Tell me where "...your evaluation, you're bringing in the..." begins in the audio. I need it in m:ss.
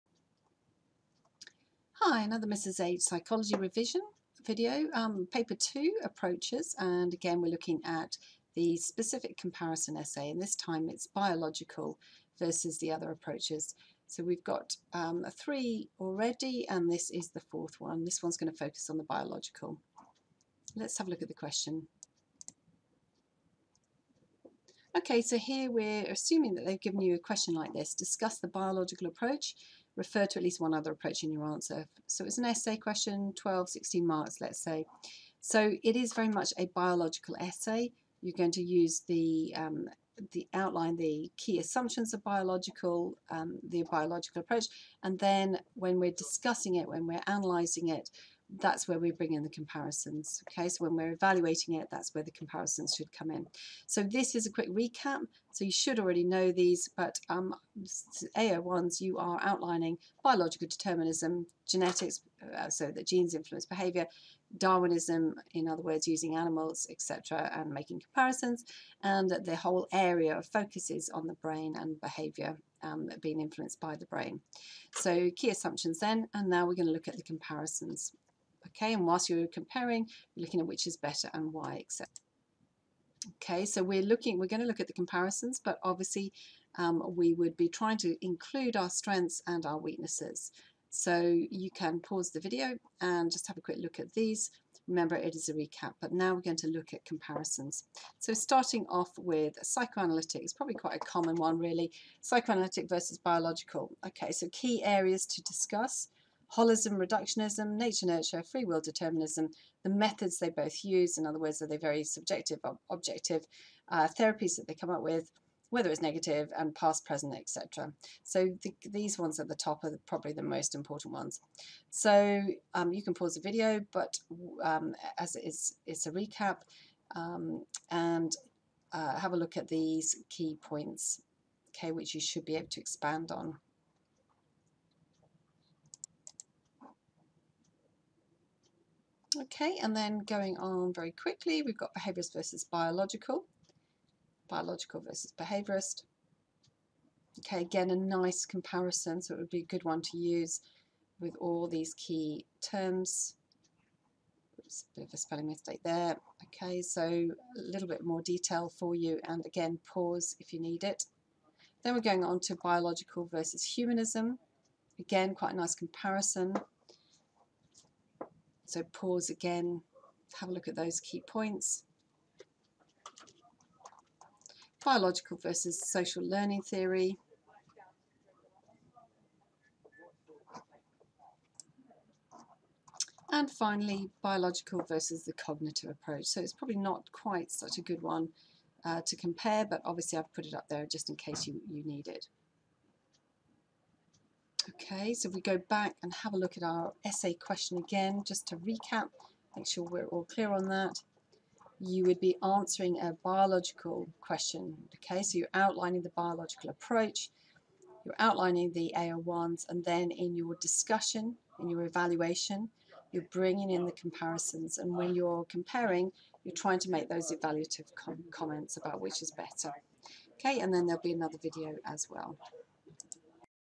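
3:31.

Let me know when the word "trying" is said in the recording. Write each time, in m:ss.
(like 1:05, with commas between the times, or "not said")
1:27, 3:36.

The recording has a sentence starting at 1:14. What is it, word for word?
So key assumptions then, and now we're going to look at the comparisons.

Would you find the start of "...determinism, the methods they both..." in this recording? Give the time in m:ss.
1:48.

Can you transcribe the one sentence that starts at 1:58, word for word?
So the, these ones at the top are probably the most important ones.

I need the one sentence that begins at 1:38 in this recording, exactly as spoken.
So starting off with psychoanalytic, it's probably quite a common one really, psychoanalytic versus biological.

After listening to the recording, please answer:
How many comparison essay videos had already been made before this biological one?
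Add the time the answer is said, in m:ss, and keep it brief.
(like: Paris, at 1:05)
3, at 0:15.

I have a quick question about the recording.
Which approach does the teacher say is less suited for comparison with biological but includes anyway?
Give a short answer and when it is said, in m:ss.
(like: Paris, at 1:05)
Cognitive approach, at 3:05.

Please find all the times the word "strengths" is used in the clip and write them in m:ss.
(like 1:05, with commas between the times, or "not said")
1:28.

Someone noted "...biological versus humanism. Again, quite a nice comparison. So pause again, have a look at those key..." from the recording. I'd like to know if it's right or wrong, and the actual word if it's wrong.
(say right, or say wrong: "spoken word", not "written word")
right.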